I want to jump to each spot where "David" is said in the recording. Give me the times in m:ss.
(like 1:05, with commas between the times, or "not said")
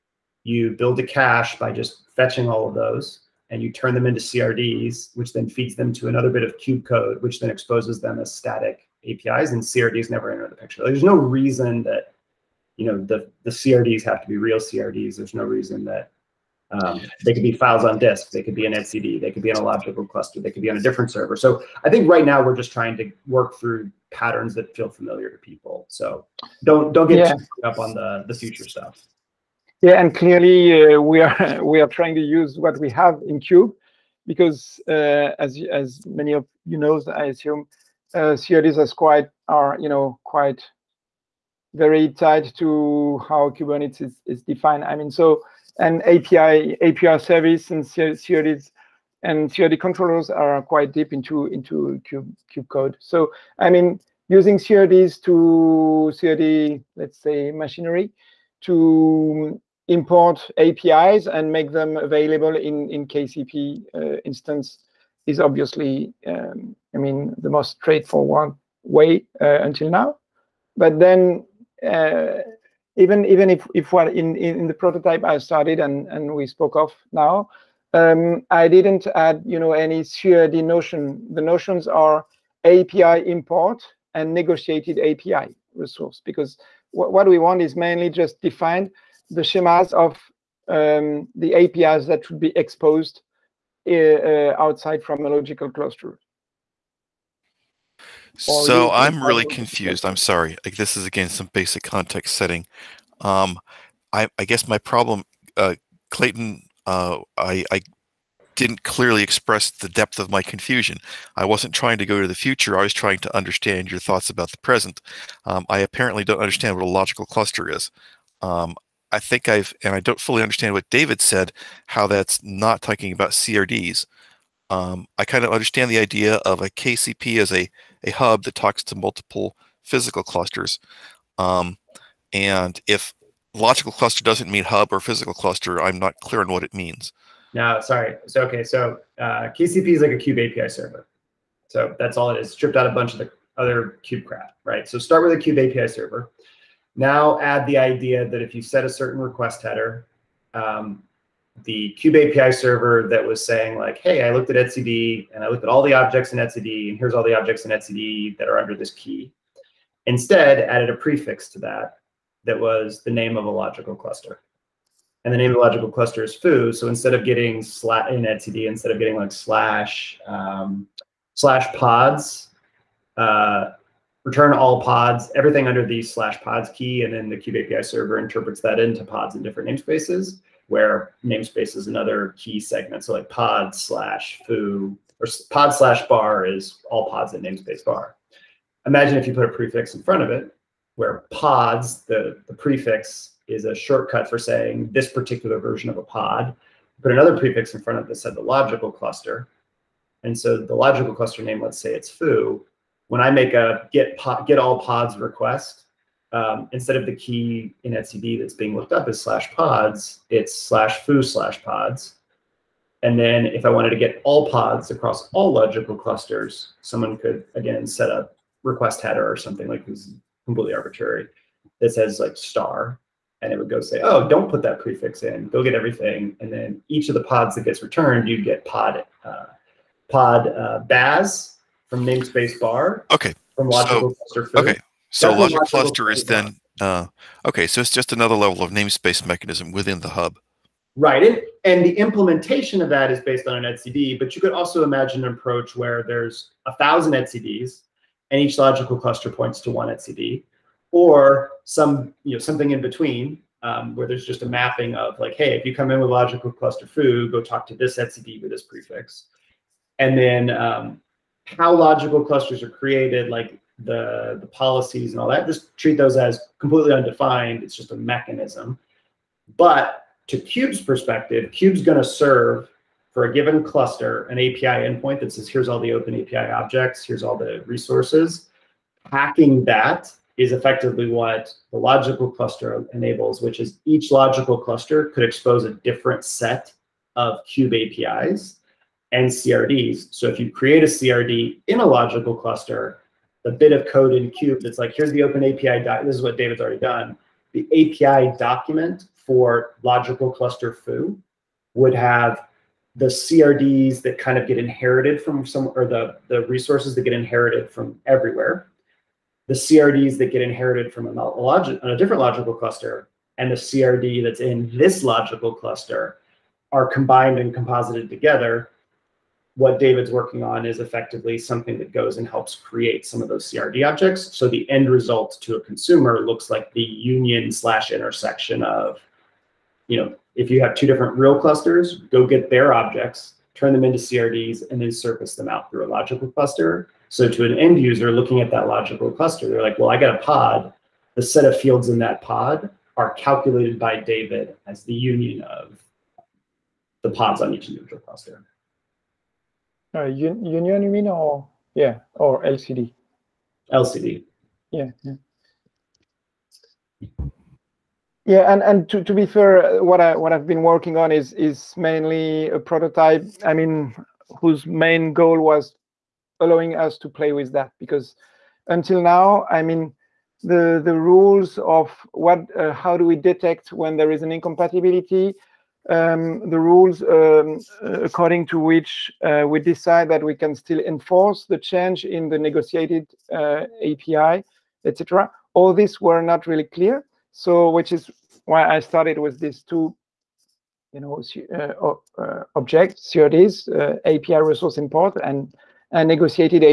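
2:00, 4:56, 5:19, 5:43.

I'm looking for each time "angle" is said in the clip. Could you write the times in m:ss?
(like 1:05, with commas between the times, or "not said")
not said.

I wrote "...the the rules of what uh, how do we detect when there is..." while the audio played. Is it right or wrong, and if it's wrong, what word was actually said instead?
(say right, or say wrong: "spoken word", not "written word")
right.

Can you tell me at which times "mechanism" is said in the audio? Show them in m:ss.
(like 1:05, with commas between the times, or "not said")
3:59, 4:27.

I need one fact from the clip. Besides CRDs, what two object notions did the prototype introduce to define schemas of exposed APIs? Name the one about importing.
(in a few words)
API import.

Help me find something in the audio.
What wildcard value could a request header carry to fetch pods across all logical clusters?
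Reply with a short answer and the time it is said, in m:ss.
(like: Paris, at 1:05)
star, at 3:42.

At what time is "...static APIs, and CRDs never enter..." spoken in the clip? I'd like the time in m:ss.
0:08.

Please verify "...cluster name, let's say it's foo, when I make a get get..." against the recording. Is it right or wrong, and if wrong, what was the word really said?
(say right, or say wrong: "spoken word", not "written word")
right.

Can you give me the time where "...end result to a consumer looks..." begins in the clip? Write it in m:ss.
5:24.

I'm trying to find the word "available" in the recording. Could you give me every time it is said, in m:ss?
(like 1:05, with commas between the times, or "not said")
1:01.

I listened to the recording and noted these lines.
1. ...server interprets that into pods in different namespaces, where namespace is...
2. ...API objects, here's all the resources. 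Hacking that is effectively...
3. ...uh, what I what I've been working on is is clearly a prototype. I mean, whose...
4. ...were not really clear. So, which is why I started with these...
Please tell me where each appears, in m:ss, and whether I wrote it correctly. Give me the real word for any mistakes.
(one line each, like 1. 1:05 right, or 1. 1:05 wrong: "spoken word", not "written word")
1. 2:57 right
2. 4:36 right
3. 5:59 wrong: "mainly", not "clearly"
4. 6:25 right.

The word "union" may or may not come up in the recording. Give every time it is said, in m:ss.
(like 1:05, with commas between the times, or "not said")
5:26, 5:44, 5:50.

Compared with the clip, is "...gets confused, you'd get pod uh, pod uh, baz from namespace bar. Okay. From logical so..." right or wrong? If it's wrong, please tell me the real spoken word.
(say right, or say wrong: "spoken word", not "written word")
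wrong: "returned", not "confused".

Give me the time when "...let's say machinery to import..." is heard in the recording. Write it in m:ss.
0:56.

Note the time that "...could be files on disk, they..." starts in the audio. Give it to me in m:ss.
0:17.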